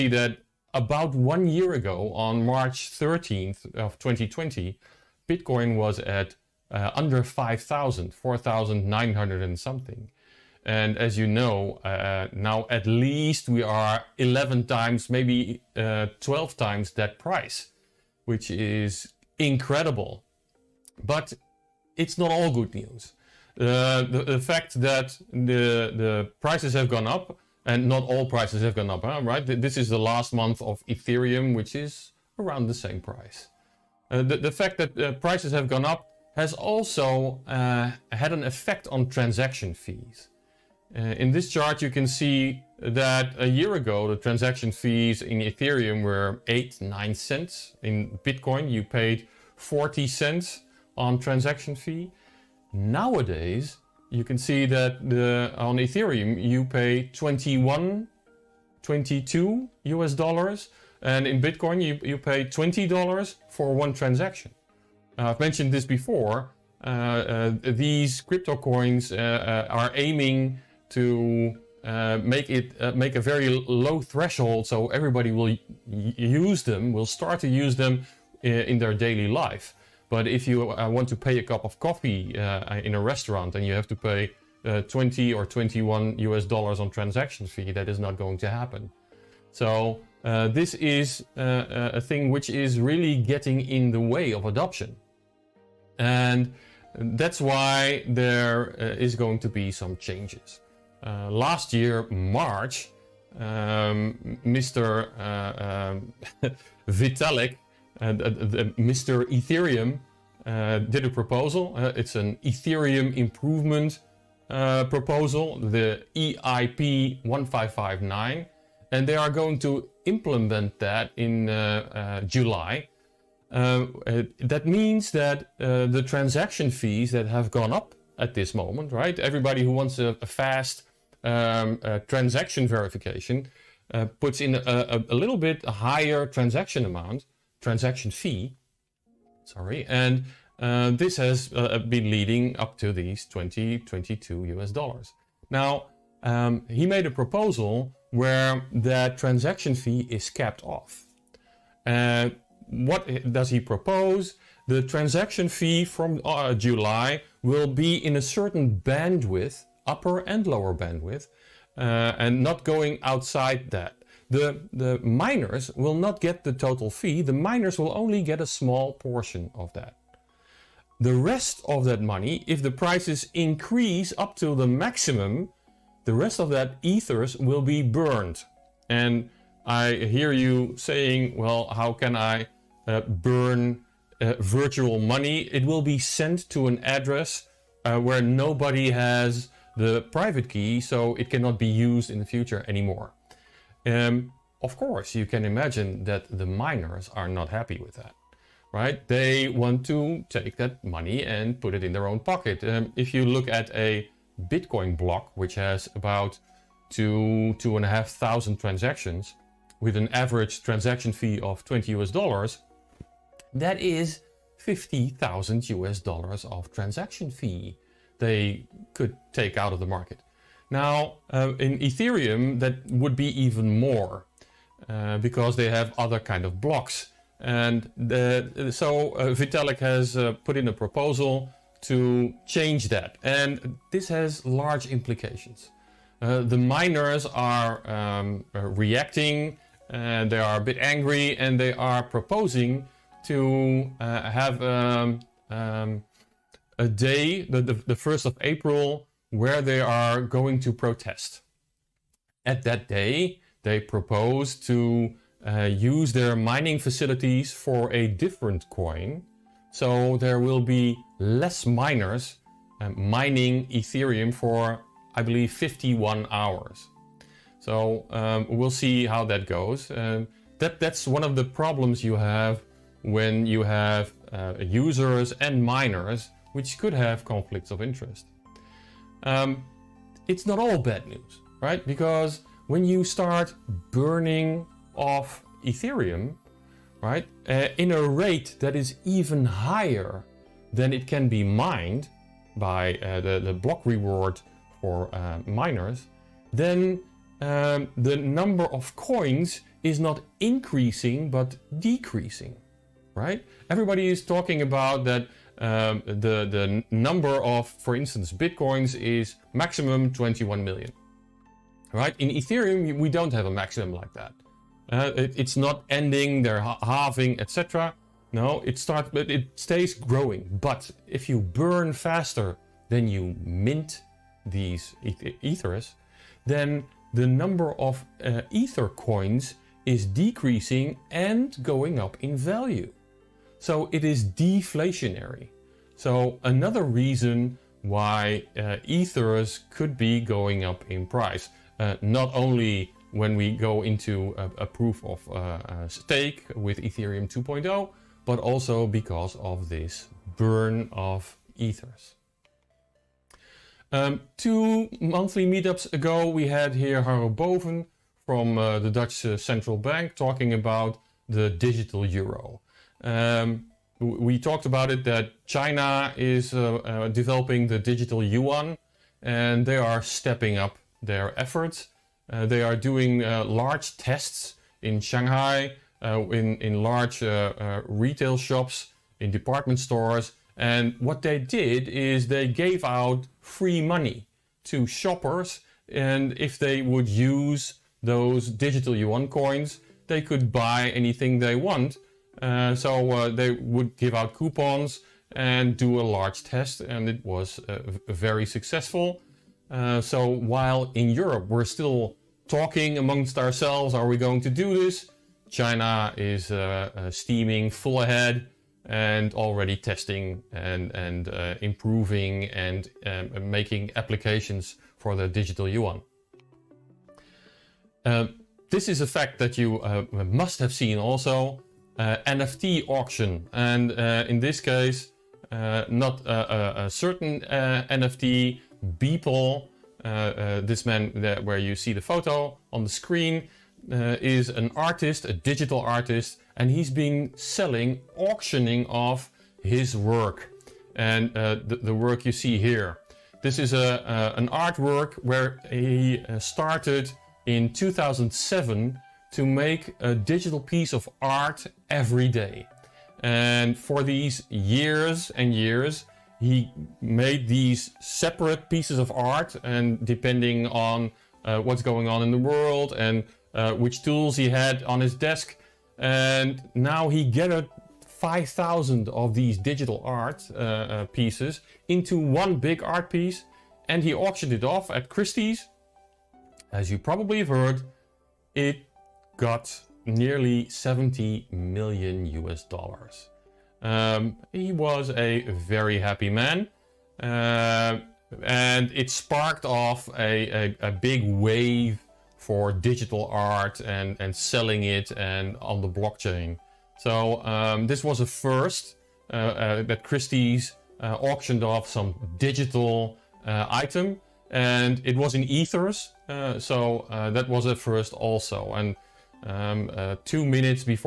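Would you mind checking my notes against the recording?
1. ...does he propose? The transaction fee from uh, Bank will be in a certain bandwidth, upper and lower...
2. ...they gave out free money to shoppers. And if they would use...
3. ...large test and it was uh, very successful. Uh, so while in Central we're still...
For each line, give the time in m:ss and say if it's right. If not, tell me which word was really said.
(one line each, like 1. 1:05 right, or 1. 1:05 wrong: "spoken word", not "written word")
1. 2:33 wrong: "July", not "Bank"
2. 6:22 right
3. 6:36 wrong: "Europe", not "Central".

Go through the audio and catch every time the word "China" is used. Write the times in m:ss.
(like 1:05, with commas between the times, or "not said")
6:05, 6:45.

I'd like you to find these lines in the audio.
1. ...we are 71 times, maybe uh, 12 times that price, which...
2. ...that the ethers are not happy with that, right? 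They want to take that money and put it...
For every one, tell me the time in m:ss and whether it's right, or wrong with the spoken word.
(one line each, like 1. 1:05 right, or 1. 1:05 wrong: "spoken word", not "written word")
1. 0:13 wrong: "11", not "71"
2. 3:16 wrong: "miners", not "ethers".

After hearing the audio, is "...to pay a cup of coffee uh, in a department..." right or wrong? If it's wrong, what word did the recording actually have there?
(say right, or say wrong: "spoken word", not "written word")
wrong: "restaurant", not "department".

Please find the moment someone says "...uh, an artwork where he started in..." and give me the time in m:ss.
7:24.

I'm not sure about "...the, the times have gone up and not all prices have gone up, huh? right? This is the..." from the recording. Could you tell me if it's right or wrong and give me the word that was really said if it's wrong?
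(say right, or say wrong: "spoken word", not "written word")
wrong: "prices", not "times".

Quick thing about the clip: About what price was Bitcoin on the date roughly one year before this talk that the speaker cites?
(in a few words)
under 5,000.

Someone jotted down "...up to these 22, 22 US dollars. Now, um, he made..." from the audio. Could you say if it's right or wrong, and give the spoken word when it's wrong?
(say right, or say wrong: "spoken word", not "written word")
wrong: "20", not "22".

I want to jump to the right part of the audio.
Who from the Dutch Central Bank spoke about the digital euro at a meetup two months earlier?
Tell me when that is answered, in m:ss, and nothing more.
5:57.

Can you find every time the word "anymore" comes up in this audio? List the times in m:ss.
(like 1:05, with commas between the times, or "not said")
3:12.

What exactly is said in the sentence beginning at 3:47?
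And the, so uh, Vitalik has uh, put in a proposal to change that.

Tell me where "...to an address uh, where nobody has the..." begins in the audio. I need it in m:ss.
3:06.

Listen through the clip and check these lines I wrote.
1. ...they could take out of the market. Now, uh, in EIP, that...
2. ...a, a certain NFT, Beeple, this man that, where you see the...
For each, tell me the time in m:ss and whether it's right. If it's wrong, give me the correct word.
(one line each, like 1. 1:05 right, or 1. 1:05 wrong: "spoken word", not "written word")
1. 3:38 wrong: "Ethereum", not "EIP"
2. 7:06 right.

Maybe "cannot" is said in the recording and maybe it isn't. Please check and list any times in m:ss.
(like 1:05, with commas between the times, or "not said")
3:11.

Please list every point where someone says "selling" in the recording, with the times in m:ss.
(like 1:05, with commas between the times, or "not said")
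7:17, 8:14.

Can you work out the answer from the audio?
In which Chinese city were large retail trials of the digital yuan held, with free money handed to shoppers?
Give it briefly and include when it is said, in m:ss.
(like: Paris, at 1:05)
Shanghai, at 6:15.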